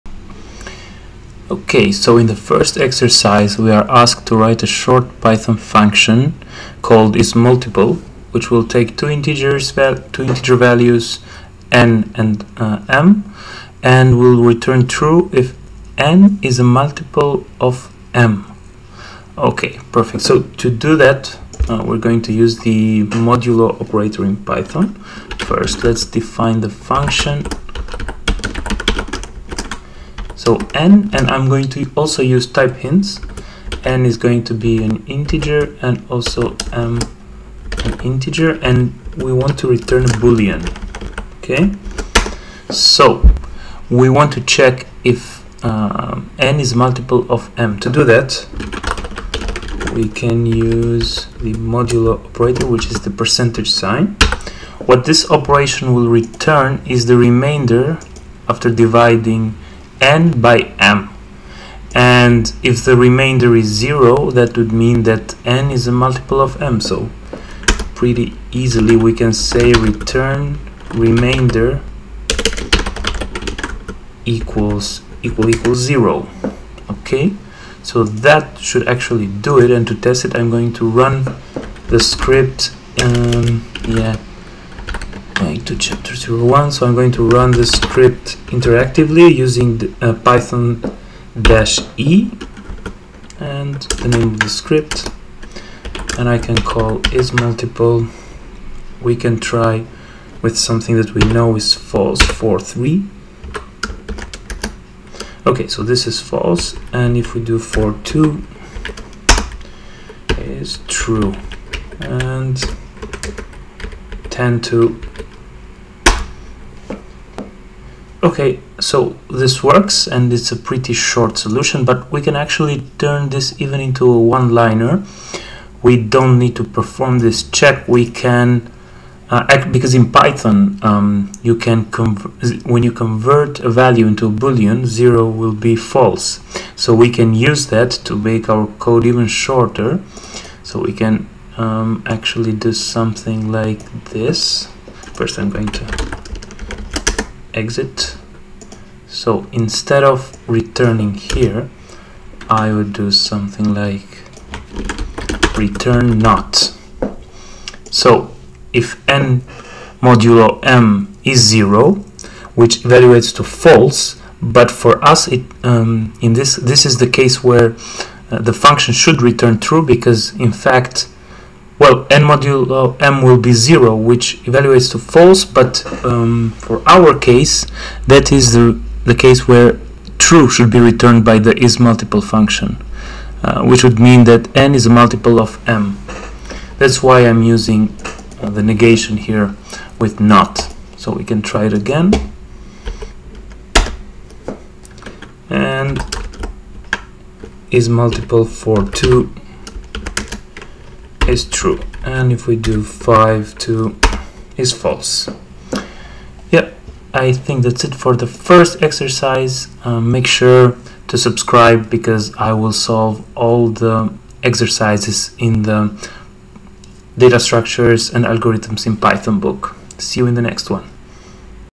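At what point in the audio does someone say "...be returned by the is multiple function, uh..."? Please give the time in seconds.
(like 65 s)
180 s.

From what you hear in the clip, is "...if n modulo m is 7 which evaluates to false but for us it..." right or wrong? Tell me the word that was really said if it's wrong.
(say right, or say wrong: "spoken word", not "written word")
wrong: "0", not "7".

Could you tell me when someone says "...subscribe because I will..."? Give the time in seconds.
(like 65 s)
211 s.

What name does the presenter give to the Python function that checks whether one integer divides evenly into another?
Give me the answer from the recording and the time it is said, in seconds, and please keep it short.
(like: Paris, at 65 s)
isMultiple, at 7 s.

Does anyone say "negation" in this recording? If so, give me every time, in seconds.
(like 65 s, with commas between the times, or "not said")
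188 s.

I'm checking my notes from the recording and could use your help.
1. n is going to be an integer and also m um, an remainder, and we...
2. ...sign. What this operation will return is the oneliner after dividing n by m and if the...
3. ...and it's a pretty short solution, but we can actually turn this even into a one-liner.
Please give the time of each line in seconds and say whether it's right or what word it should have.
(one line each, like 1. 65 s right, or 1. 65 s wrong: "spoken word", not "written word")
1. 33 s wrong: "integer", not "remainder"
2. 53 s wrong: "remainder", not "oneliner"
3. 120 s right.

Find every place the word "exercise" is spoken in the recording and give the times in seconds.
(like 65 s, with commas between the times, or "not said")
2 s, 208 s, 214 s.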